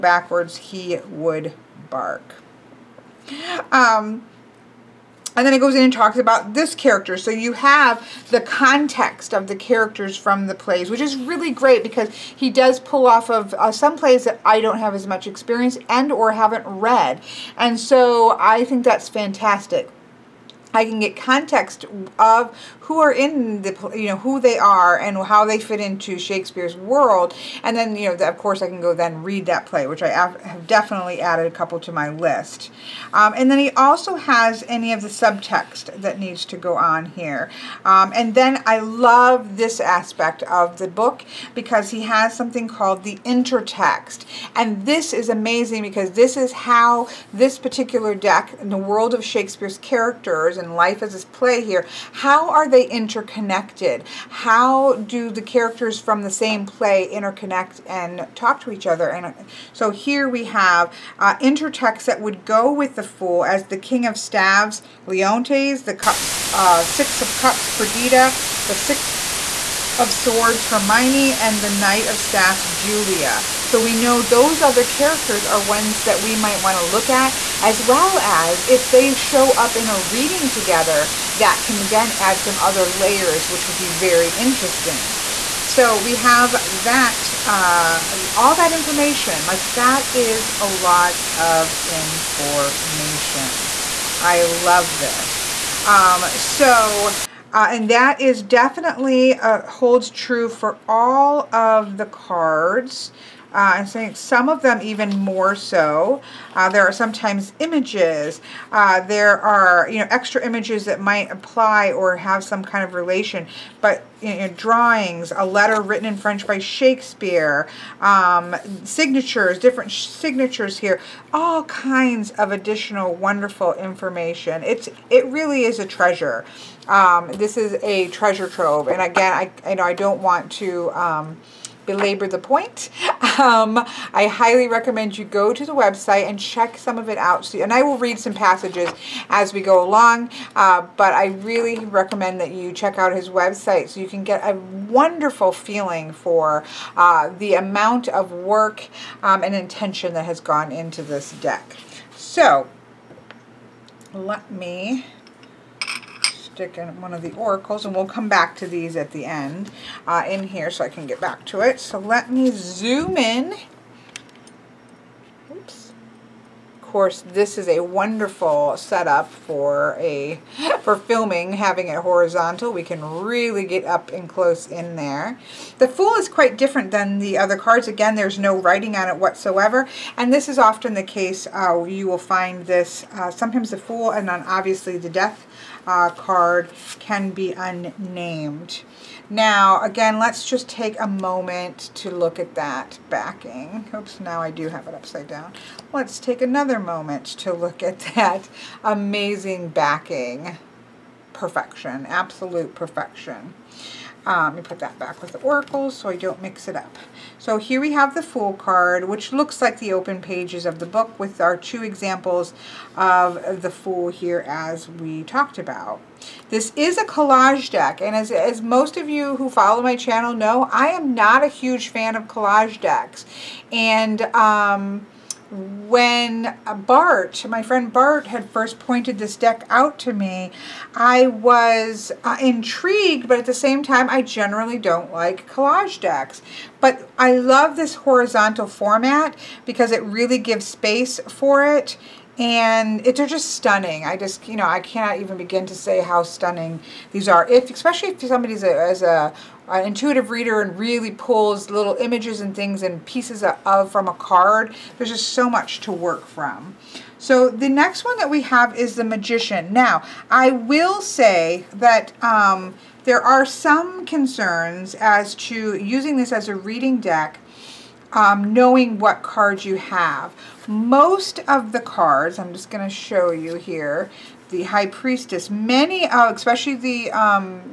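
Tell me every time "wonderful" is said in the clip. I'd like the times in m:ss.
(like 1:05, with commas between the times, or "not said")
2:03, 2:24, 2:47.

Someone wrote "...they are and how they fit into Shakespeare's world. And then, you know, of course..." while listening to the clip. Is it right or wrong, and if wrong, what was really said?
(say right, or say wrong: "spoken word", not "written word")
right.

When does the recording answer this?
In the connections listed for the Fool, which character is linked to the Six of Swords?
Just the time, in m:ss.
1:10.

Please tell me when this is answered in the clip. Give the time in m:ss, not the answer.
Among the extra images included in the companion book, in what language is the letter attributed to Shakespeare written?
1:56.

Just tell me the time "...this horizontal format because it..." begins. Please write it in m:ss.
3:57.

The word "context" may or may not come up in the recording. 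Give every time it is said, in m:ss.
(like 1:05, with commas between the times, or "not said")
0:08, 0:21.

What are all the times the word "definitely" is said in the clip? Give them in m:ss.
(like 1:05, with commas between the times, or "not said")
0:30, 1:38.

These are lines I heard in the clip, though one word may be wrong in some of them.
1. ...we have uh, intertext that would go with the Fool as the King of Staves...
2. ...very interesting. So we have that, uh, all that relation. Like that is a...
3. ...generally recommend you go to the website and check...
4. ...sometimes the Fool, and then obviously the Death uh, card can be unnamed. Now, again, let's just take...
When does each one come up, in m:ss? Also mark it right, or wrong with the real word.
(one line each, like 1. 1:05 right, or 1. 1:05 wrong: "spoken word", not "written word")
1. 1:00 right
2. 1:23 wrong: "information", not "relation"
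3. 2:14 wrong: "highly", not "generally"
4. 3:03 right.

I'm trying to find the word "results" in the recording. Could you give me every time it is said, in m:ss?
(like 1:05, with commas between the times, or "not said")
not said.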